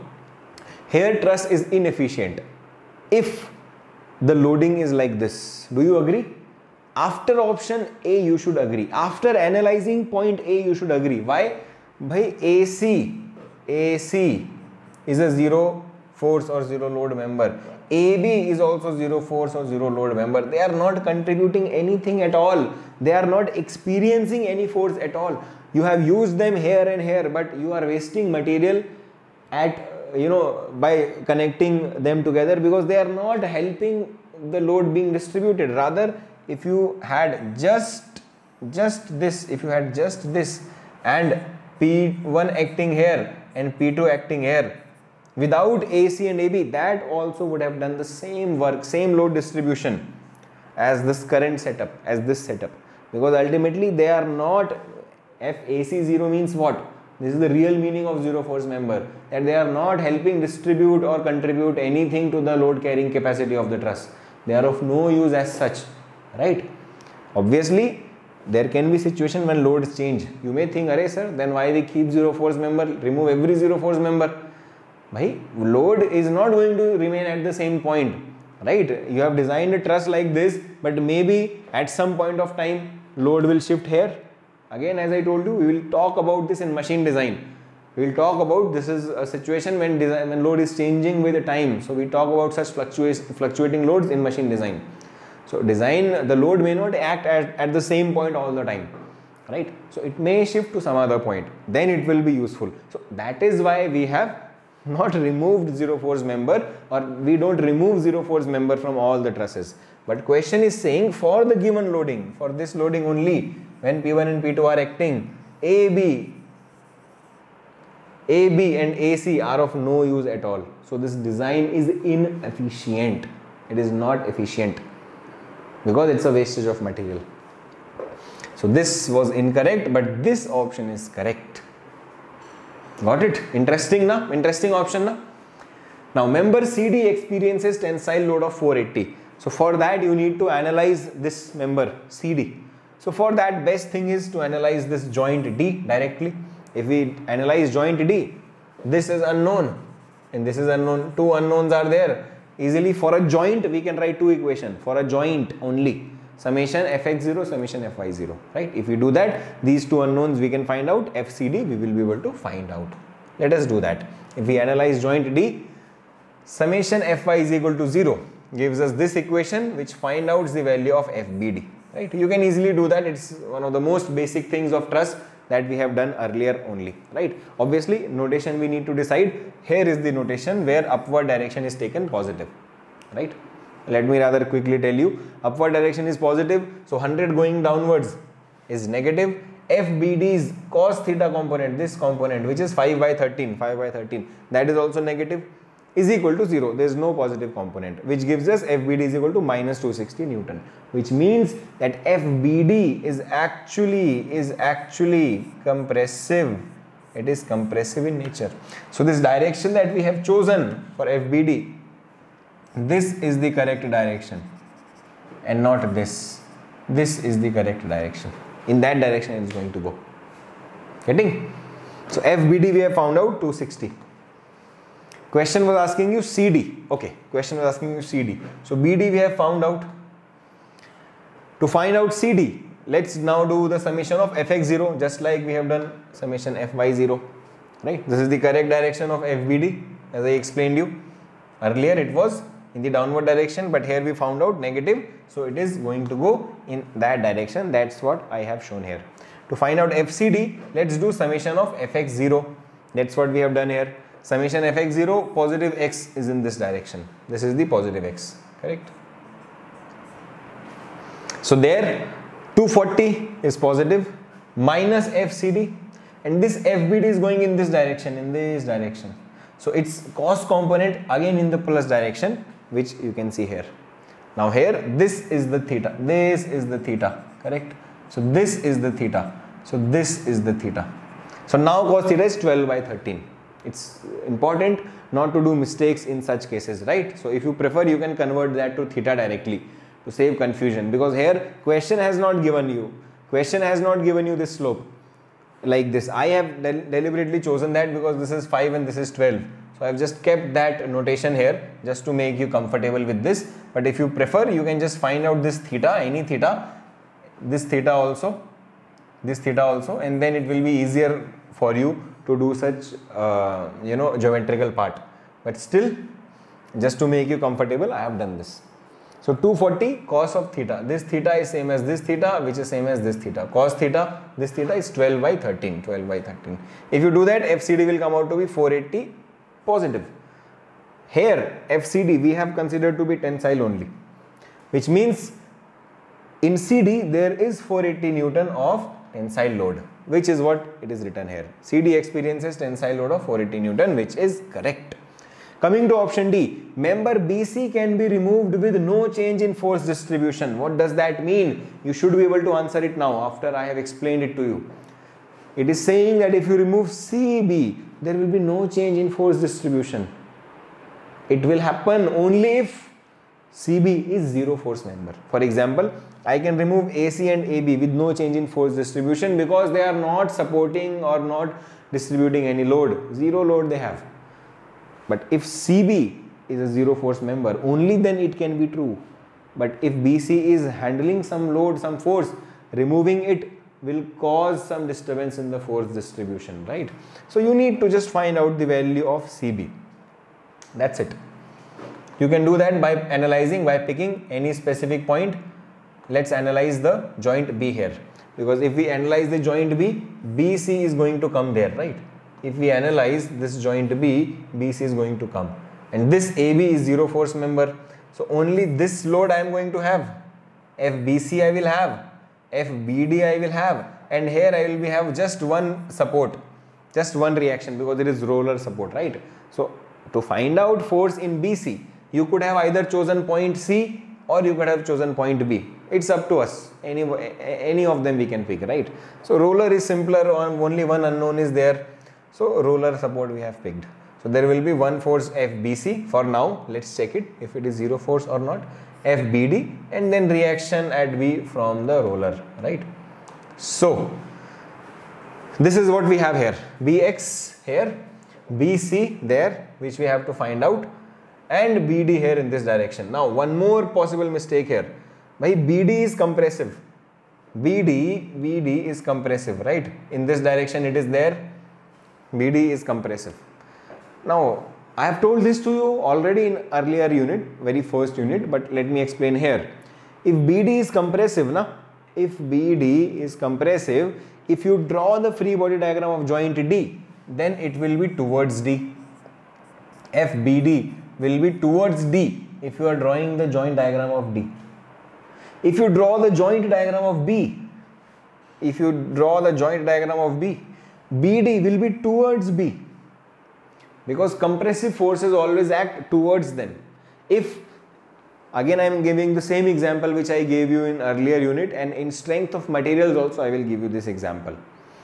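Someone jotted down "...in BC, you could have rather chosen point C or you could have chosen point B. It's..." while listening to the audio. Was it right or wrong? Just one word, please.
wrong.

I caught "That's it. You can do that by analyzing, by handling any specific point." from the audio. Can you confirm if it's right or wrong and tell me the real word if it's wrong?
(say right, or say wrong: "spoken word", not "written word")
wrong: "picking", not "handling".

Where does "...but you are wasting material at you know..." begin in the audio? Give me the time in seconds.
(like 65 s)
27 s.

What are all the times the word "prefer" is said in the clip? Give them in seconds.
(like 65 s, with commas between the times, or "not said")
287 s, 304 s.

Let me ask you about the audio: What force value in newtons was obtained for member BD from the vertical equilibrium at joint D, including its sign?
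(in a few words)
-260 N.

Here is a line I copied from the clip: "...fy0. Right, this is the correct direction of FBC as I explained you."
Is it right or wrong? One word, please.
wrong.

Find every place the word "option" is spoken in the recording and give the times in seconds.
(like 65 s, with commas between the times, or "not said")
7 s, 130 s, 134 s, 345 s.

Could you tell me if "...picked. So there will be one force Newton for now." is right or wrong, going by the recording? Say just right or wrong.
wrong.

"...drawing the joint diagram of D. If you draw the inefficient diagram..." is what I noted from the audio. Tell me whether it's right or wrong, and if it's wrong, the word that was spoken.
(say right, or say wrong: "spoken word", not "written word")
wrong: "joint", not "inefficient".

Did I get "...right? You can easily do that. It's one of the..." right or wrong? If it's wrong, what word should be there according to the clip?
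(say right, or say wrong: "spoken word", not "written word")
right.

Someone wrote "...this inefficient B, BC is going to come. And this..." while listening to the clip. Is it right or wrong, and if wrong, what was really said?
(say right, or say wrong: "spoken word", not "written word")
wrong: "joint", not "inefficient".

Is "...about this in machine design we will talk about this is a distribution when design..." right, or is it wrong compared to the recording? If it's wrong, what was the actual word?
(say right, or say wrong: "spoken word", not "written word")
wrong: "situation", not "distribution".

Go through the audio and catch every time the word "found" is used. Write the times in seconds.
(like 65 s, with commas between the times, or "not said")
222 s, 229 s, 244 s.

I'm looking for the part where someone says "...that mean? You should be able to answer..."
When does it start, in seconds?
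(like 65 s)
350 s.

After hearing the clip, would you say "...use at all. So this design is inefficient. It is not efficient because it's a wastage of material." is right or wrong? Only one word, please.
right.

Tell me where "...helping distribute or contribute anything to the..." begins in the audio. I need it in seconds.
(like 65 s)
59 s.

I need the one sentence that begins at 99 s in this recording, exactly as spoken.
So it may shift to some other point, then it will be useful.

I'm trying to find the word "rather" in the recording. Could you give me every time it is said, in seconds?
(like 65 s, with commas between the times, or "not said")
35 s, 184 s.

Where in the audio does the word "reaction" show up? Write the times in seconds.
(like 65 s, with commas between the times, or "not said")
417 s, 440 s.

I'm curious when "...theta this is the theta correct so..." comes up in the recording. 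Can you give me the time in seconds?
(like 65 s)
275 s.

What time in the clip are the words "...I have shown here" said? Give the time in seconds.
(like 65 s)
248 s.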